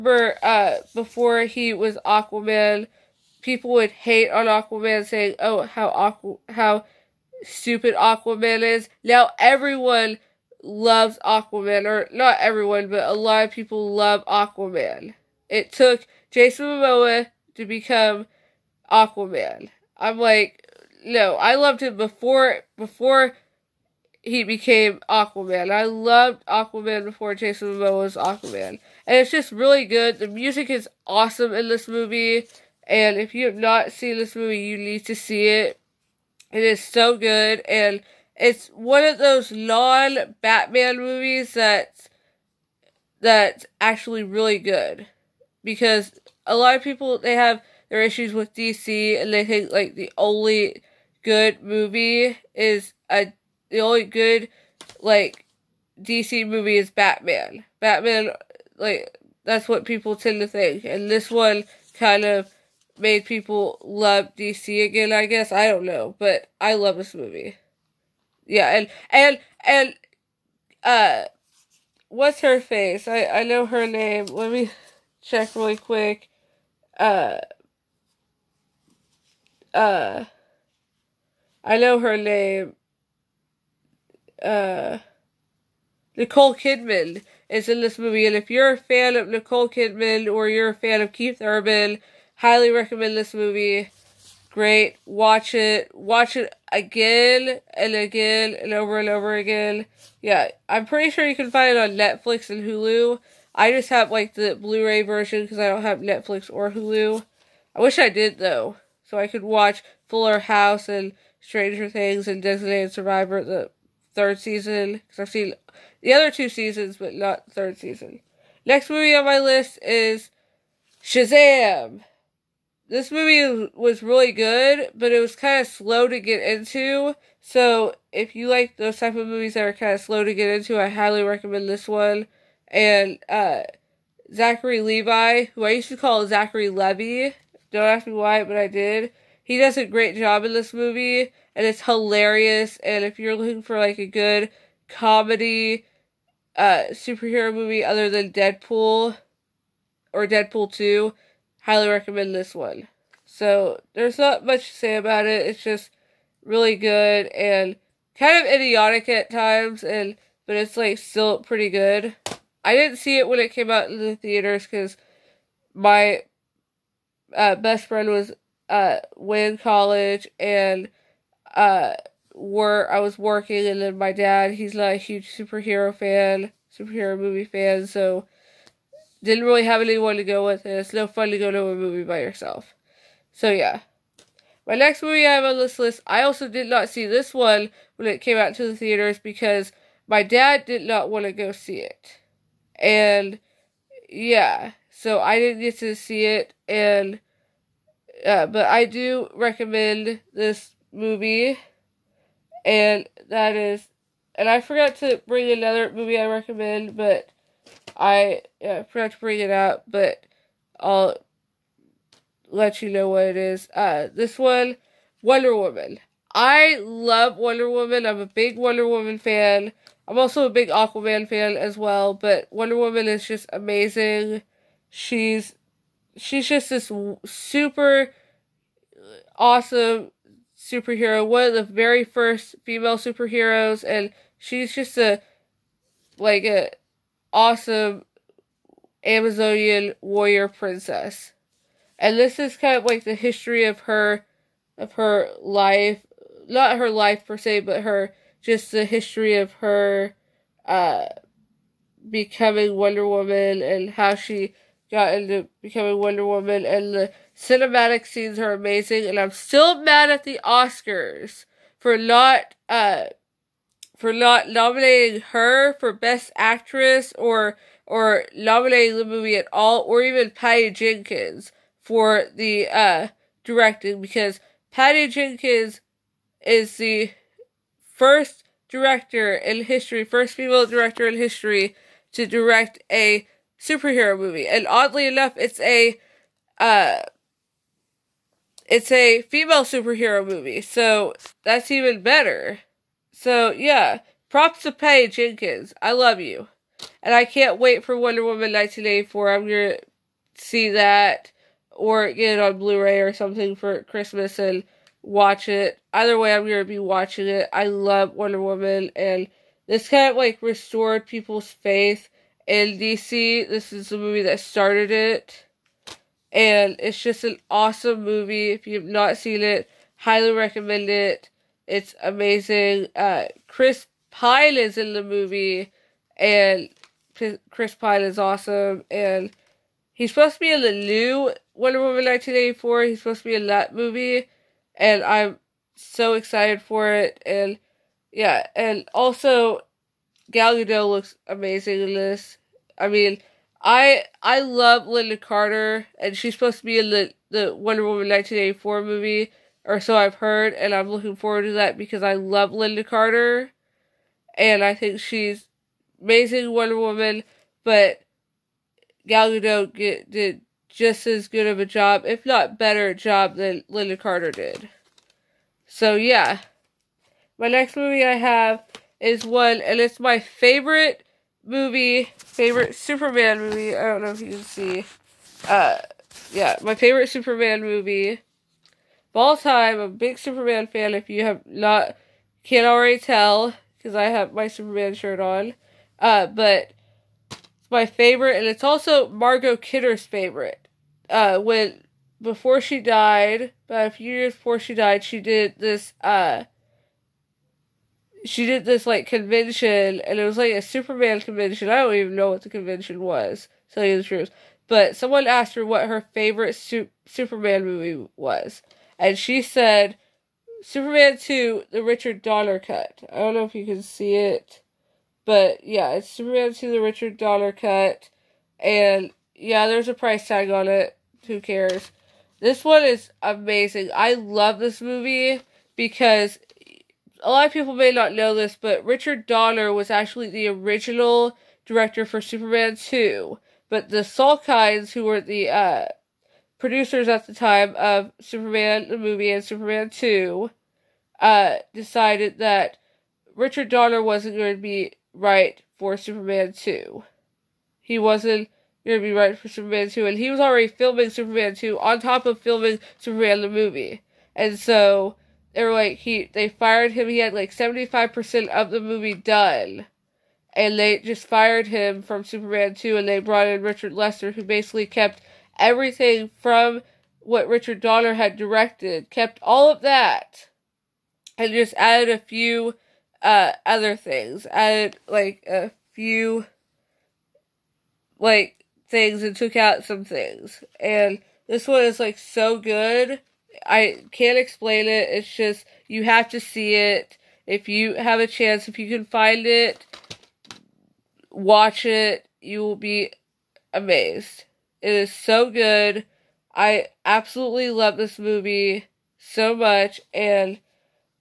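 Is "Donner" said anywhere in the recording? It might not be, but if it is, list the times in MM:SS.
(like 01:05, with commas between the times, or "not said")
06:52, 06:57, 07:09, 07:23, 07:47.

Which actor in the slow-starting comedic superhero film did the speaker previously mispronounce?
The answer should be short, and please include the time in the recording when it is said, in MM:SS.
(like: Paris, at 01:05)
Zachary Levi, at 02:14.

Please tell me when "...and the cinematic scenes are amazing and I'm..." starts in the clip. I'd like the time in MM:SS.
04:16.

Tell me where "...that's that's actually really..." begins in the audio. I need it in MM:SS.
00:41.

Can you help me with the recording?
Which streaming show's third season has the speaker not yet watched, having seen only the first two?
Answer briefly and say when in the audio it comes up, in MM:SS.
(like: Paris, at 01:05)
Designated Survivor, at 01:52.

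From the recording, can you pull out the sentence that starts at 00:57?
Batman like that's what people tend to think and this one kind of made people love DC again, I guess.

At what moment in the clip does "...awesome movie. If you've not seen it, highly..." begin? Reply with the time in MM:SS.
05:17.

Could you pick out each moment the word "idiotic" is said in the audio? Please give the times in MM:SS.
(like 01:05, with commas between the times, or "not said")
02:38.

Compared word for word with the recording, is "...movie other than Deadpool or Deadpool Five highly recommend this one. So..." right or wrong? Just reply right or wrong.
wrong.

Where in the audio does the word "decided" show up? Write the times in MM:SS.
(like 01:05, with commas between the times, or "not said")
07:21.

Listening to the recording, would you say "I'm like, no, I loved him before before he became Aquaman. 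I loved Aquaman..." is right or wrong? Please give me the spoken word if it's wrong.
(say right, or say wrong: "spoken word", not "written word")
right.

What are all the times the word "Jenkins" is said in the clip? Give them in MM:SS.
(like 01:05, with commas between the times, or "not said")
04:30, 04:35, 04:55.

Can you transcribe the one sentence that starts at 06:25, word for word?
Uh, but it's my favorite, and it's also Margot Kidder's favorite.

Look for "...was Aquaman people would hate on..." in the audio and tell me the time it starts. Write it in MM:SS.
00:01.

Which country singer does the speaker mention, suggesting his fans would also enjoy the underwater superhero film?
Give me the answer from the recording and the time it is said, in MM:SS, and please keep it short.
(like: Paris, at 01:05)
Keith Urban, at 01:31.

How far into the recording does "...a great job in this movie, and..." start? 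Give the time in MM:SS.
02:19.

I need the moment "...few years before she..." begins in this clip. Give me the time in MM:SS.
06:33.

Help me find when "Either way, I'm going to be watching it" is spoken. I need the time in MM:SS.
05:05.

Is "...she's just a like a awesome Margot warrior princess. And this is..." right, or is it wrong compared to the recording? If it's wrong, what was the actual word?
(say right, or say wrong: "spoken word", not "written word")
wrong: "Amazonian", not "Margot".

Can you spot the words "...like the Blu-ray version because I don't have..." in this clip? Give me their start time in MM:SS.
01:44.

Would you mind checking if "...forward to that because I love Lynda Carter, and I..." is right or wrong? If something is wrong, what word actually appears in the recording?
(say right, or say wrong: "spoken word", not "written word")
right.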